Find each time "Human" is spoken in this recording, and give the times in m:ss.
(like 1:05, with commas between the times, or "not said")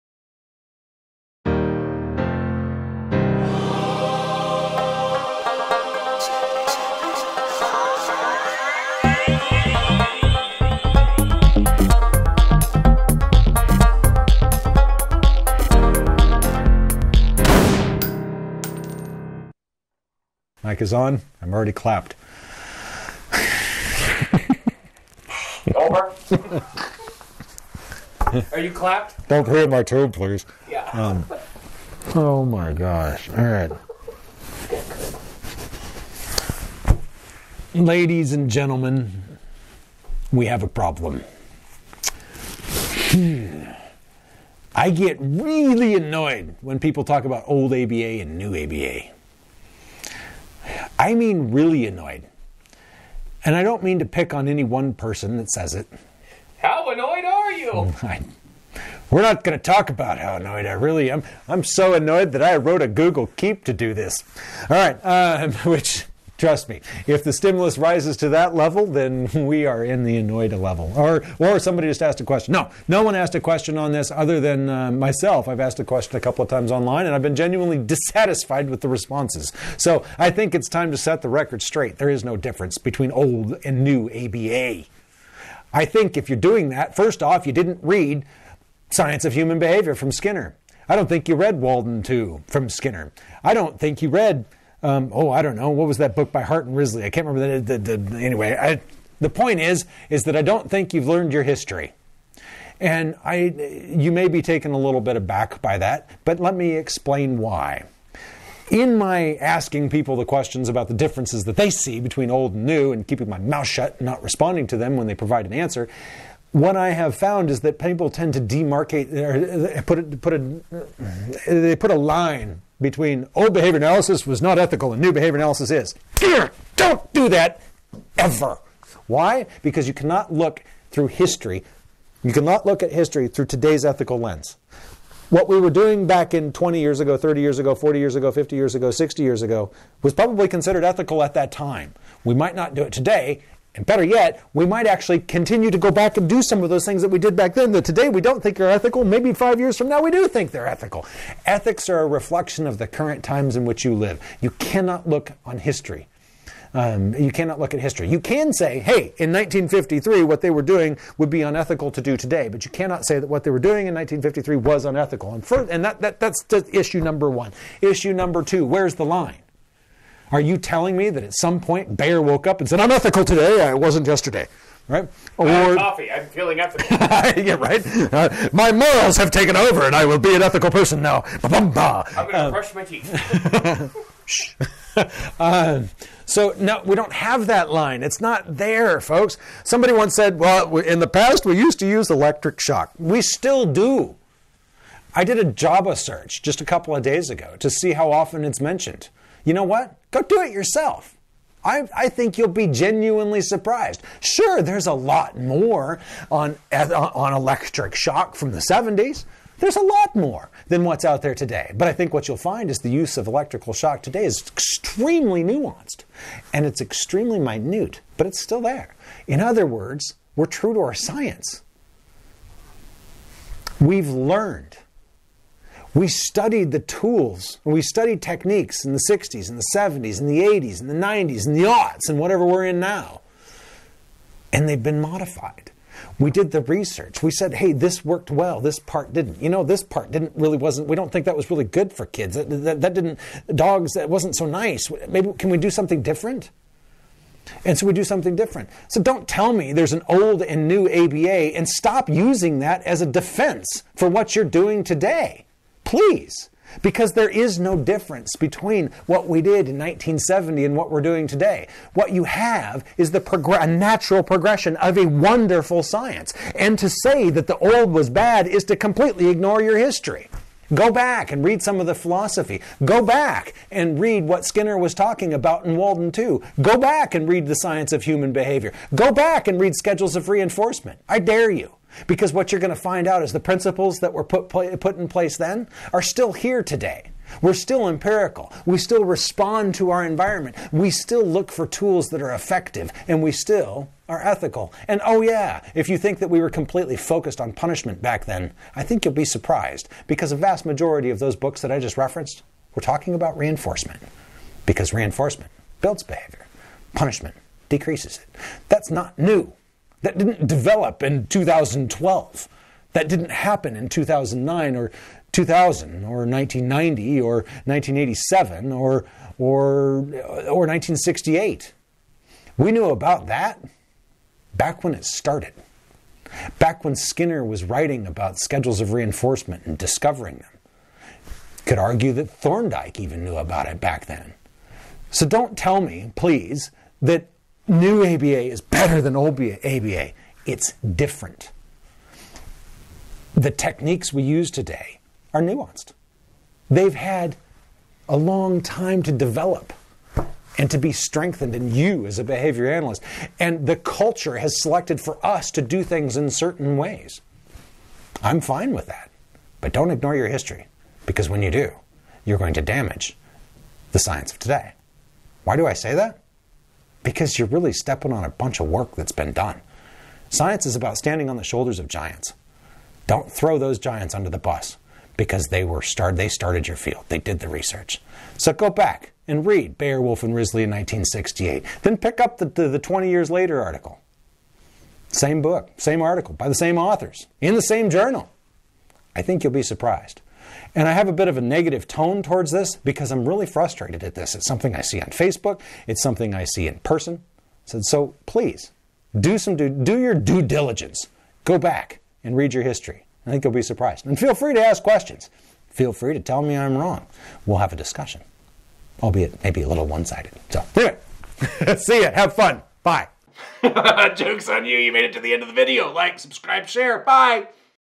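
1:29, 4:38.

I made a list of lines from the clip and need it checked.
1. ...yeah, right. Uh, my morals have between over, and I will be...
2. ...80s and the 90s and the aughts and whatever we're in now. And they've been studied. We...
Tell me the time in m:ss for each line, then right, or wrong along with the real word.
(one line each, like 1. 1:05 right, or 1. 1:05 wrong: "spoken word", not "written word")
1. 2:57 wrong: "taken", not "between"
2. 3:50 wrong: "modified", not "studied".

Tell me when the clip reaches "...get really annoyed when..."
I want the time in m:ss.
0:44.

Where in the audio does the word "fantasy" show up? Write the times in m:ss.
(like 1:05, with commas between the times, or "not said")
not said.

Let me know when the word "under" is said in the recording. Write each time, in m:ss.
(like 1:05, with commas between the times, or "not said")
6:14.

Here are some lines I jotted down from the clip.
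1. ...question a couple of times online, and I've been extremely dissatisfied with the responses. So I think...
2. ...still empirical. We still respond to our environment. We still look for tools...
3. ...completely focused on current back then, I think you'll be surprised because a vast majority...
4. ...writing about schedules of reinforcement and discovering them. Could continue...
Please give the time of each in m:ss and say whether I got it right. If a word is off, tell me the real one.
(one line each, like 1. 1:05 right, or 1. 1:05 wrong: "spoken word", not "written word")
1. 1:15 wrong: "genuinely", not "extremely"
2. 4:47 right
3. 4:56 wrong: "punishment", not "current"
4. 5:27 wrong: "argue", not "continue".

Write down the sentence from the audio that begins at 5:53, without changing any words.
And the culture has selected for us to do things in certain ways.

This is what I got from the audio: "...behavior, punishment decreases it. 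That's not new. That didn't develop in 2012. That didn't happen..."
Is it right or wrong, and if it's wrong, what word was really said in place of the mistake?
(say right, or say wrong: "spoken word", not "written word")
right.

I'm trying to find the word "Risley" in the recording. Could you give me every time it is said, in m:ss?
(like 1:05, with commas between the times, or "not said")
1:36, 6:20.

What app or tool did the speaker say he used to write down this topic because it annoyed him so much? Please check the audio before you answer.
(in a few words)
Google Keep.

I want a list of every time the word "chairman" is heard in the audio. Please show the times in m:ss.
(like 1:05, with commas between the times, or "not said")
not said.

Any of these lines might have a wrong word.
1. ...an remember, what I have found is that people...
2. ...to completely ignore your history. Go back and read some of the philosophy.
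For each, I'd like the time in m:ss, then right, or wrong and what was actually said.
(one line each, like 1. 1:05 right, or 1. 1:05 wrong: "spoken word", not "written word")
1. 1:55 wrong: "answer", not "remember"
2. 4:28 right.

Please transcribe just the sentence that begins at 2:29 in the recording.
Maybe five years from now we do think they're ethical.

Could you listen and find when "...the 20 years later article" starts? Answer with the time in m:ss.
6:22.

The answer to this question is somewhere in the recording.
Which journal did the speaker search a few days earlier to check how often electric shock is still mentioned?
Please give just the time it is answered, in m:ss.
3:15.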